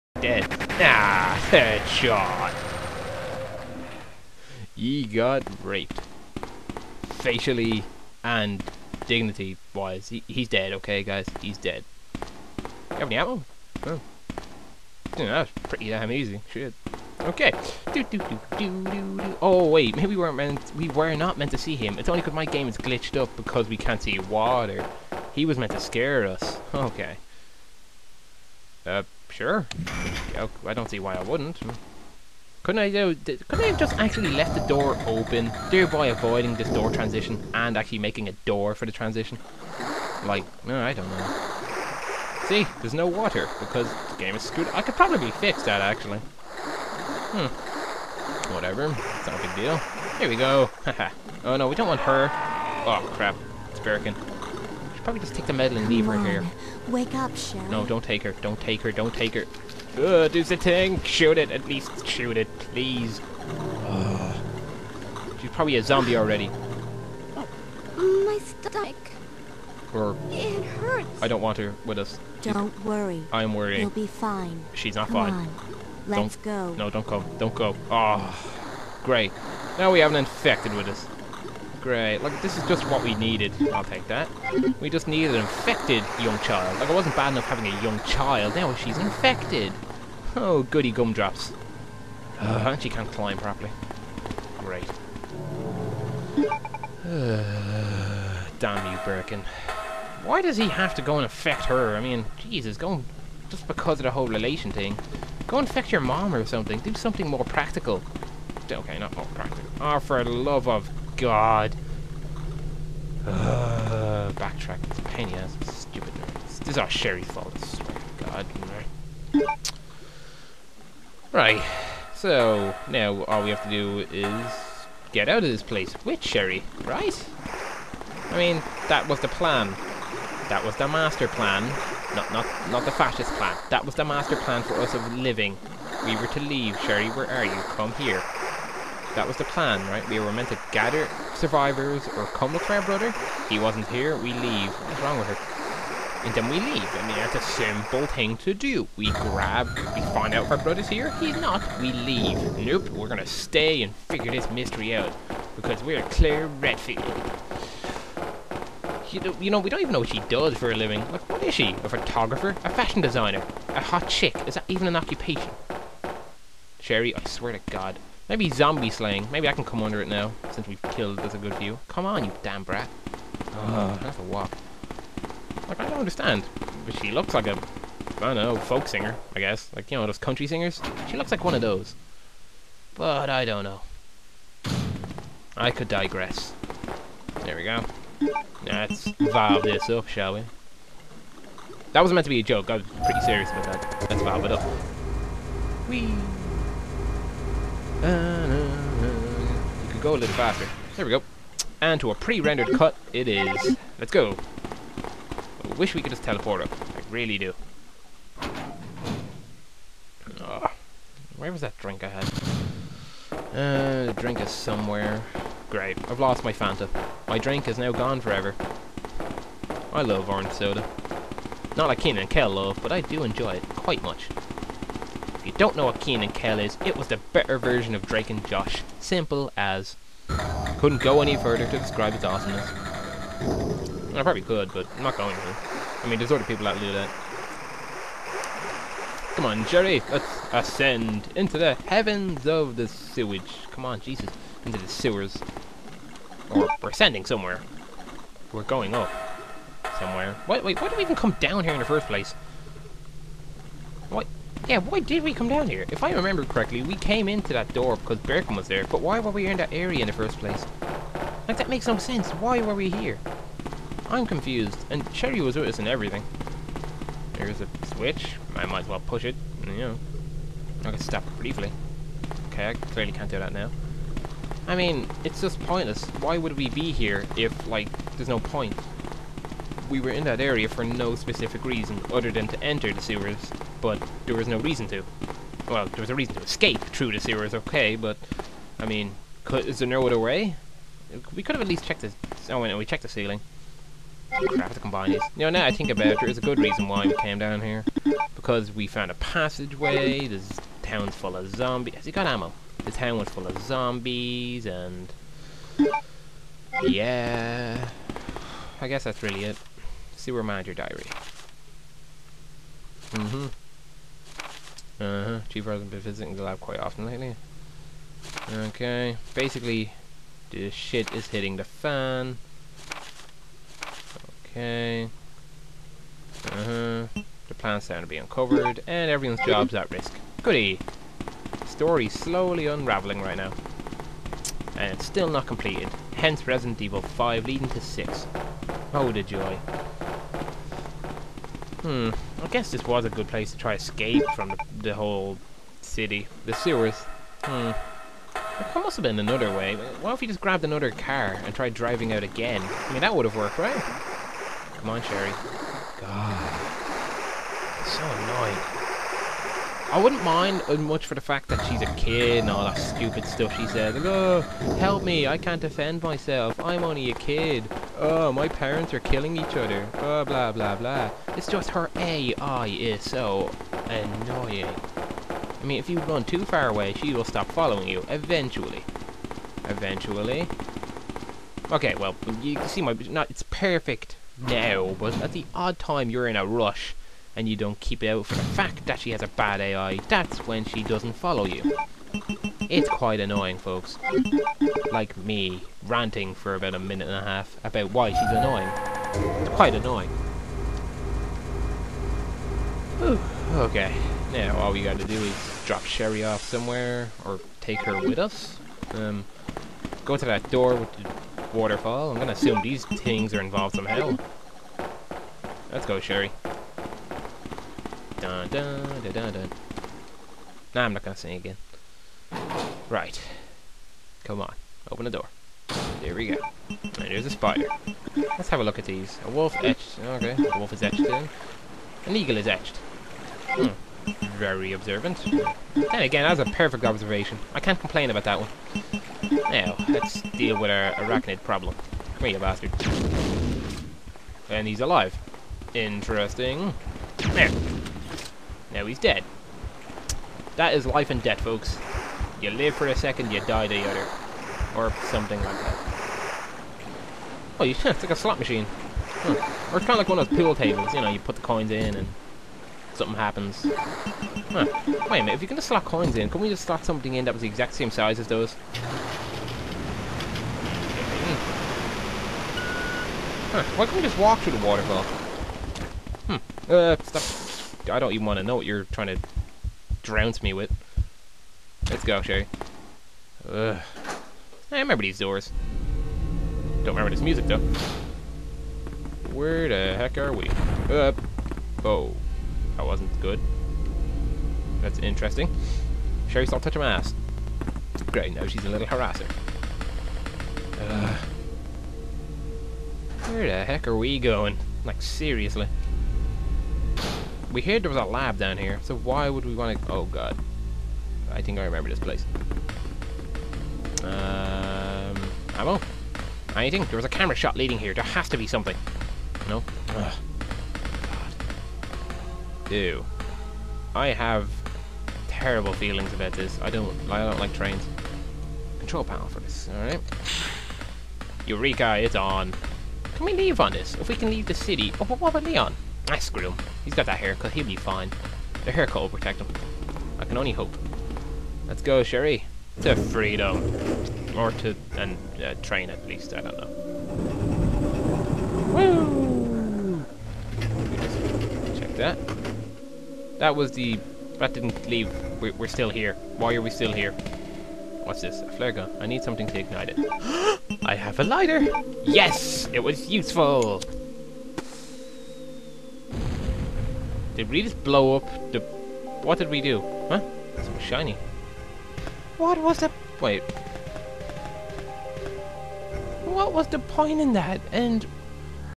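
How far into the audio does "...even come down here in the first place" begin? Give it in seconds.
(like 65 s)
251 s.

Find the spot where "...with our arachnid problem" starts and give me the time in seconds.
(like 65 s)
440 s.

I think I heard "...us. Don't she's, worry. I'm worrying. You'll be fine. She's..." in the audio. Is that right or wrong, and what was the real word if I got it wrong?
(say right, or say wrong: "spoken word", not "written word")
right.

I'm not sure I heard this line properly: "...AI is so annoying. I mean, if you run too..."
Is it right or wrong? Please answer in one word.
right.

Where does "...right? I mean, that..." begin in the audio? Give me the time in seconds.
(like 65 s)
126 s.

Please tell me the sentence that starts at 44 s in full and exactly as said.
I could probably fix that actually.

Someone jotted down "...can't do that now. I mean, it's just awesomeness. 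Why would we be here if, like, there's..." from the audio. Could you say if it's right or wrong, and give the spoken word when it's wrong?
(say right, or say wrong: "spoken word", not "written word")
wrong: "pointless", not "awesomeness".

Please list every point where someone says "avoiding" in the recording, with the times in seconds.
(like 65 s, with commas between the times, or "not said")
36 s.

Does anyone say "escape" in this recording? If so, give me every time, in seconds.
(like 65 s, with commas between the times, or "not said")
286 s, 343 s.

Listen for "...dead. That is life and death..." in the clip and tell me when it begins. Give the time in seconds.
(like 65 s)
448 s.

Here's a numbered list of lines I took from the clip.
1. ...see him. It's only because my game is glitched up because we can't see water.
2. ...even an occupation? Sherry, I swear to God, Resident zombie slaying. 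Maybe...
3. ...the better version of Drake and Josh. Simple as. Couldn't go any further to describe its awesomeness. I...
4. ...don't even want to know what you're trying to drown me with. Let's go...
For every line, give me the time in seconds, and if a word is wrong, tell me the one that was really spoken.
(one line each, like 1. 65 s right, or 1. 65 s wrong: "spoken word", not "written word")
1. 21 s right
2. 164 s wrong: "Maybe", not "Resident"
3. 227 s right
4. 477 s right.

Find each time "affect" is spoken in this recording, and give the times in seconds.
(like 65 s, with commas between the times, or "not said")
101 s, 105 s.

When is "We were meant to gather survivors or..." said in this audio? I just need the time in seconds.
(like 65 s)
140 s.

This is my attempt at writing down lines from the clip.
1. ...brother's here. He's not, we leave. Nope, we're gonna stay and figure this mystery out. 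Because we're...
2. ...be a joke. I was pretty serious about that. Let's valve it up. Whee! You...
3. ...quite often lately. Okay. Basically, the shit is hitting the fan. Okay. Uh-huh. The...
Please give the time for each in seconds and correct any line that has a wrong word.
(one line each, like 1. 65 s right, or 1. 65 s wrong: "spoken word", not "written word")
1. 150 s right
2. 192 s right
3. 316 s right.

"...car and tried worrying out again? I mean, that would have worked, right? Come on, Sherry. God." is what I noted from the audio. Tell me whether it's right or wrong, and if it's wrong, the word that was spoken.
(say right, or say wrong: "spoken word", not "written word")
wrong: "driving", not "worrying".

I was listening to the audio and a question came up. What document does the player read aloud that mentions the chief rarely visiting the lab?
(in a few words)
Sewer Manager Diary.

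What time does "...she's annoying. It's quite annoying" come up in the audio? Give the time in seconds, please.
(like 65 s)
398 s.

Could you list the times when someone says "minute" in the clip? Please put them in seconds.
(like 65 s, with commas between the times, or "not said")
396 s, 465 s.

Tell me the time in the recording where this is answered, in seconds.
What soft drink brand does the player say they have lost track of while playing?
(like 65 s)
216 s.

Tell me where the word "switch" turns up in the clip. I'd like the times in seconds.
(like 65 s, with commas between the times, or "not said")
267 s.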